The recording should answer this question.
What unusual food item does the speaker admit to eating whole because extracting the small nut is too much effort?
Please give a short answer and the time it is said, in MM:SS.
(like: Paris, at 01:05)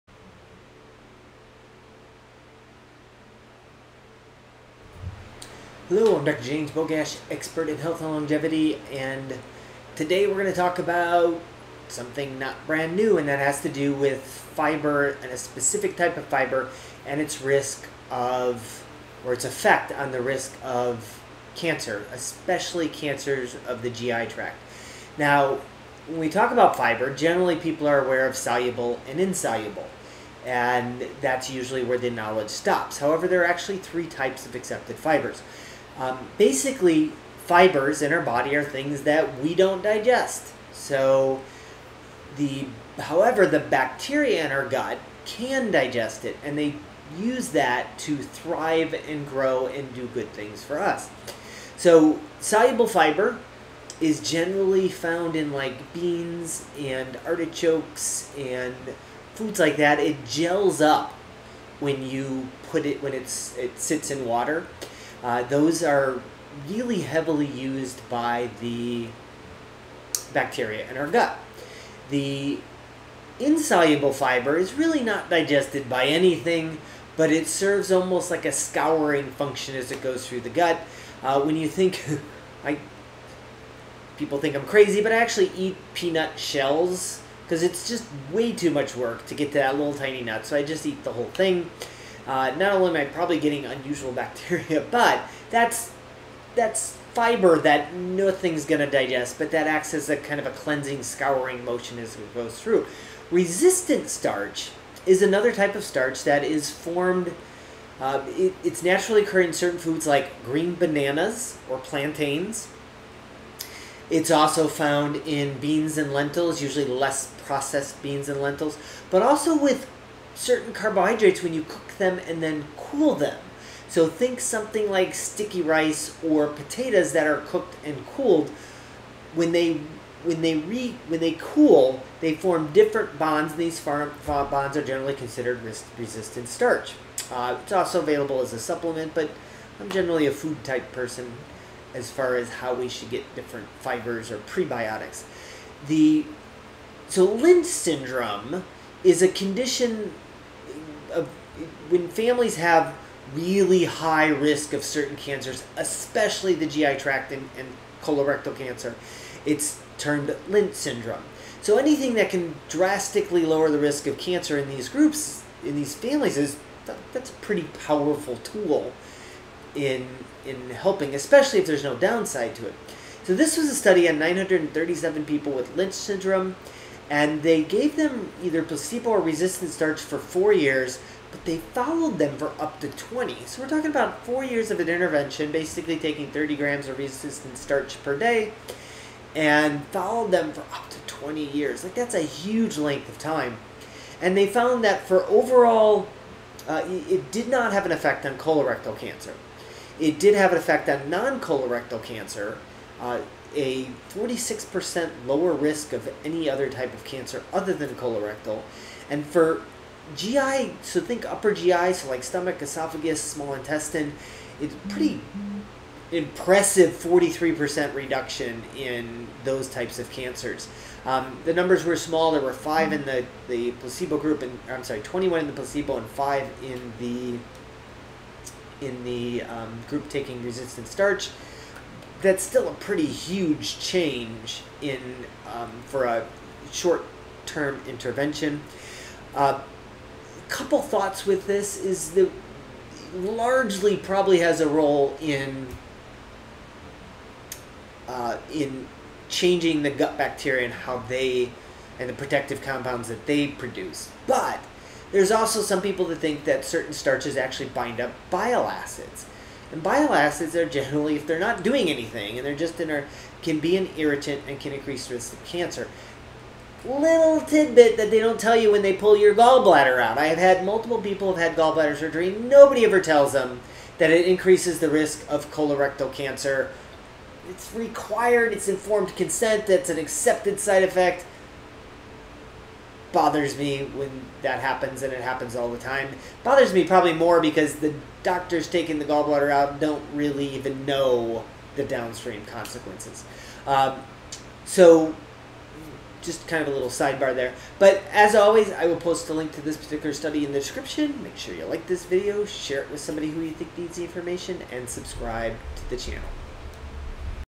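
peanut shells, at 01:25.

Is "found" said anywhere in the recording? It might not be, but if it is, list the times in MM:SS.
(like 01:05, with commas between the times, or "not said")
00:54, 01:54, 03:14.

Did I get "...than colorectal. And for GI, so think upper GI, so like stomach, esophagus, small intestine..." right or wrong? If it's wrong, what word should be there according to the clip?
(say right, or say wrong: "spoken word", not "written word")
right.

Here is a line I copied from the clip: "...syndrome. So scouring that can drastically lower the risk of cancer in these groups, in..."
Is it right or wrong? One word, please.
wrong.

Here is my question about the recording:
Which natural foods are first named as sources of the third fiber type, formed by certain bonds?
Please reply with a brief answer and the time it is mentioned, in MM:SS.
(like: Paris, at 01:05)
green bananas or plantains, at 01:50.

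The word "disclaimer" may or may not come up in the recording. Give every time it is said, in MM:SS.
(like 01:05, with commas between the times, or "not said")
not said.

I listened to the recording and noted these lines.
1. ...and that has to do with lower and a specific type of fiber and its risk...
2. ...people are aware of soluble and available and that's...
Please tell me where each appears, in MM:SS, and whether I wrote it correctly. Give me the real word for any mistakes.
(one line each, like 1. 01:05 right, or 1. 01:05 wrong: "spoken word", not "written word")
1. 00:13 wrong: "fiber", not "lower"
2. 00:27 wrong: "insoluble", not "available".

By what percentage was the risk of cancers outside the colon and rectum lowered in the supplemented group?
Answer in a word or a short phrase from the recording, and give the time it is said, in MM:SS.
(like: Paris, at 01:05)
46%, at 03:24.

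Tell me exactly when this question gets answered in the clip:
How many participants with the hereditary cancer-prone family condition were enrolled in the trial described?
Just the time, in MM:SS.
02:54.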